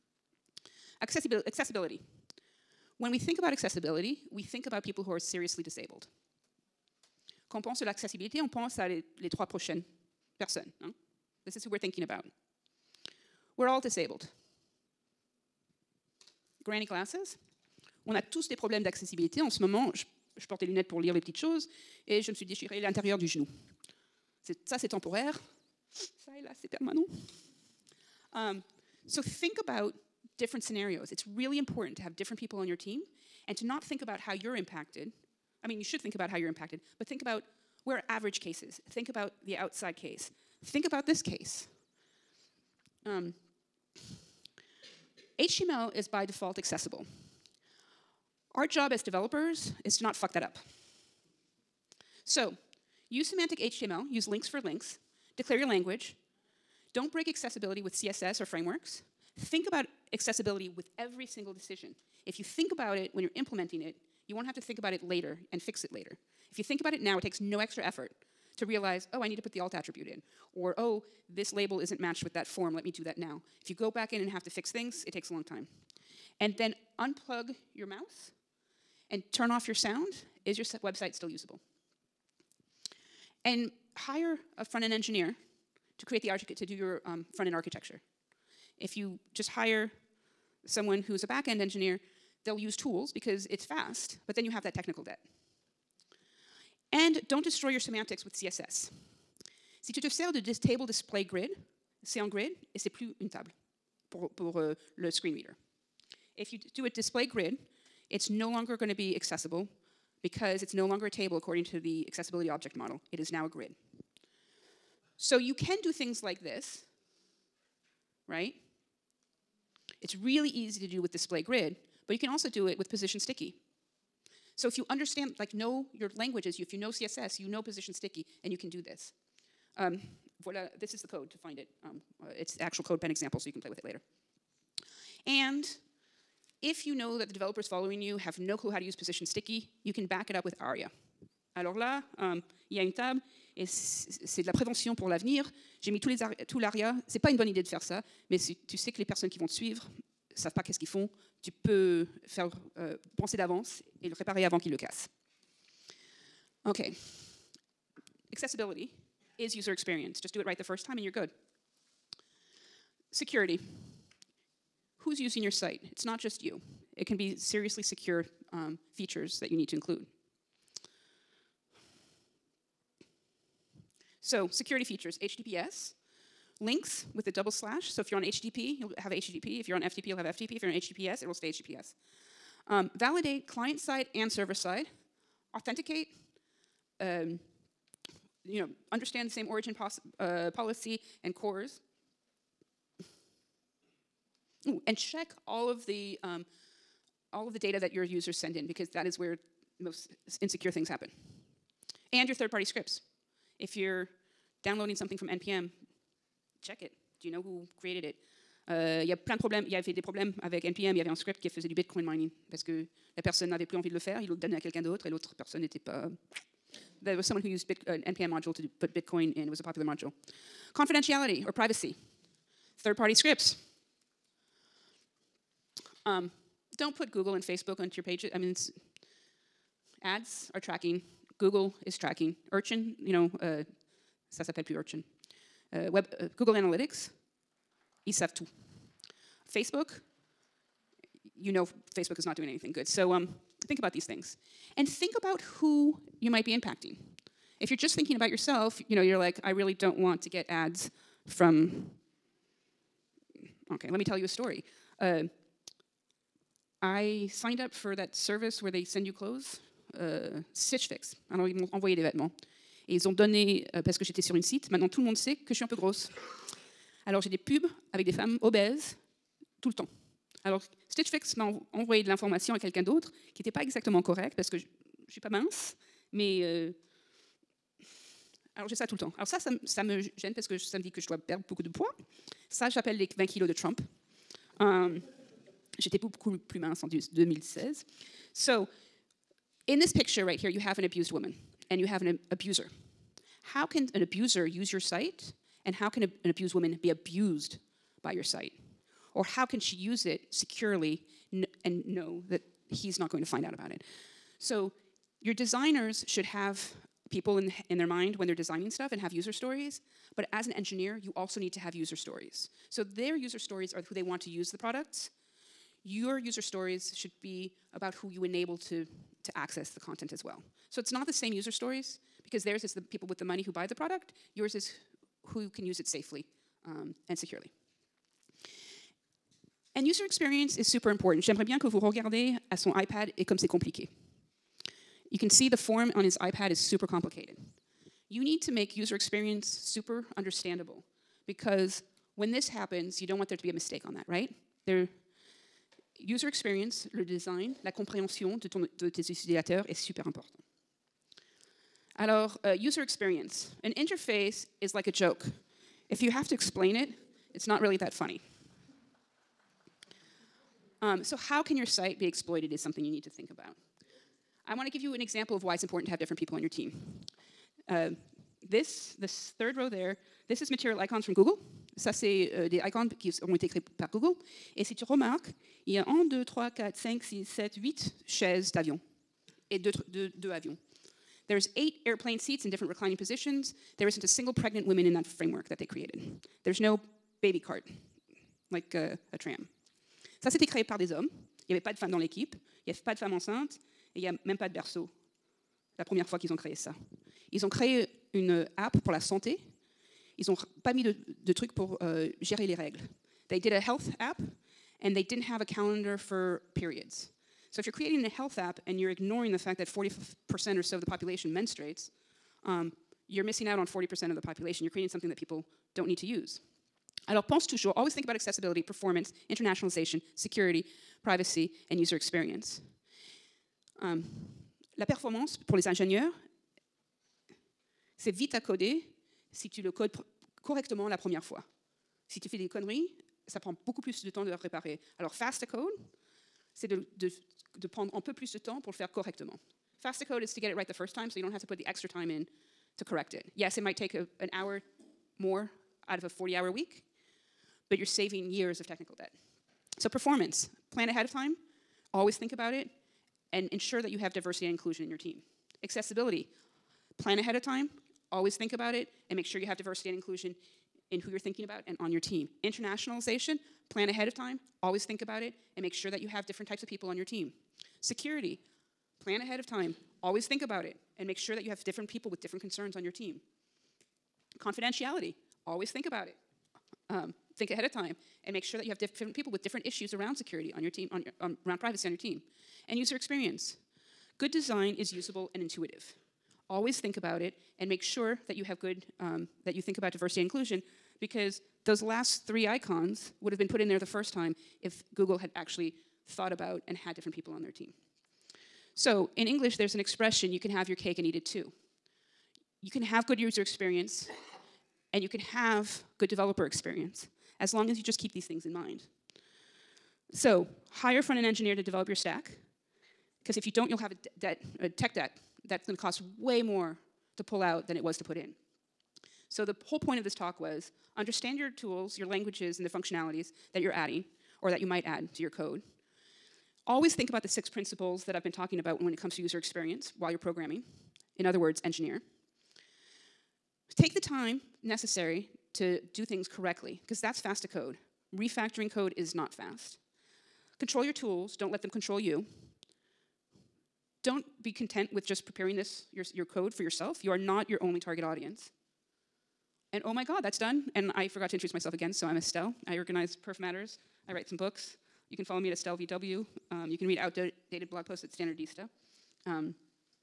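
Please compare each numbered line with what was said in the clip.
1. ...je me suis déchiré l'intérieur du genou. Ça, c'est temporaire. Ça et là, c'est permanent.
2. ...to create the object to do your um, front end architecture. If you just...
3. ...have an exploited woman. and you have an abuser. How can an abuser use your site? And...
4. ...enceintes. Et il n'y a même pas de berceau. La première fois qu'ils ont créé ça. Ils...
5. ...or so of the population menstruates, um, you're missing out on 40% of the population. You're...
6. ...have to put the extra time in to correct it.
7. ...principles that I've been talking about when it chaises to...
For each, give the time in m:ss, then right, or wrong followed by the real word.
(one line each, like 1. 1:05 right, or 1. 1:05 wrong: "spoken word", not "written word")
1. 0:22 right
2. 1:25 wrong: "architect", not "object"
3. 4:50 wrong: "abused", not "exploited"
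4. 6:33 right
5. 6:50 right
6. 7:21 right
7. 8:47 wrong: "comes", not "chaises".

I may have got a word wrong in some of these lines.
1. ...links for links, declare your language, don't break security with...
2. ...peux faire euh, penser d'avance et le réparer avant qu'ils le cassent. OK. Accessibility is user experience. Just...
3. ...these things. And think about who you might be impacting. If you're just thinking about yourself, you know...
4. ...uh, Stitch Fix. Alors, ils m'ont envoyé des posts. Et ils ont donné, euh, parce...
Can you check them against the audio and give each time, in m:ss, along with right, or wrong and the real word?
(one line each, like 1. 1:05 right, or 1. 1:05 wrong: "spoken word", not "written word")
1. 0:54 wrong: "accessibility", not "security"
2. 2:31 right
3. 4:03 right
4. 4:19 wrong: "vêtements", not "posts".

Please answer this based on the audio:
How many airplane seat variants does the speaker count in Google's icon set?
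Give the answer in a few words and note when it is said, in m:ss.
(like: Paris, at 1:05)
8, at 6:21.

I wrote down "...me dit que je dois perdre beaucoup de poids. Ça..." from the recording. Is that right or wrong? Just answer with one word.
right.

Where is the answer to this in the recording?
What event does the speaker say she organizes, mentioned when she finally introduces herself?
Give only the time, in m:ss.
9:13.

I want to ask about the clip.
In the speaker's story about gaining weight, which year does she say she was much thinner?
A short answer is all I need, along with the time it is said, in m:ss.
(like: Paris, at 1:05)
2016, at 4:46.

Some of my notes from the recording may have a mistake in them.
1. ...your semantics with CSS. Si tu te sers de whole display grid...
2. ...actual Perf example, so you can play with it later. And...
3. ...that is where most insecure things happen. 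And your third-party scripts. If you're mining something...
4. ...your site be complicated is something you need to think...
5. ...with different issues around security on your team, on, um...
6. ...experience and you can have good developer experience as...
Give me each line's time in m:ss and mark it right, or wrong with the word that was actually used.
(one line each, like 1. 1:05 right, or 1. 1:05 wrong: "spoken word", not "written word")
1. 1:37 wrong: "table", not "whole"
2. 2:12 wrong: "CodePen", not "Perf"
3. 3:18 wrong: "downloading", not "mining"
4. 6:01 wrong: "exploited", not "complicated"
5. 7:59 right
6. 8:23 right.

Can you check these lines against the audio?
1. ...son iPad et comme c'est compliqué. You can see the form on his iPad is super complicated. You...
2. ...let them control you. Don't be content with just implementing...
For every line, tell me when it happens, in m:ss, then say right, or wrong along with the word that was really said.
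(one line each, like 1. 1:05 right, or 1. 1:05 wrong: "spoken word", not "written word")
1. 5:32 right
2. 9:01 wrong: "preparing", not "implementing".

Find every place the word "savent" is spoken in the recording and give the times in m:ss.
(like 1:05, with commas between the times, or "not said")
2:30, 3:58.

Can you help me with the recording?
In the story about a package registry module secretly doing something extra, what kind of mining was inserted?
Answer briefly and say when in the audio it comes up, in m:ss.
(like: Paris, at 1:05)
Bitcoin mining, at 3:31.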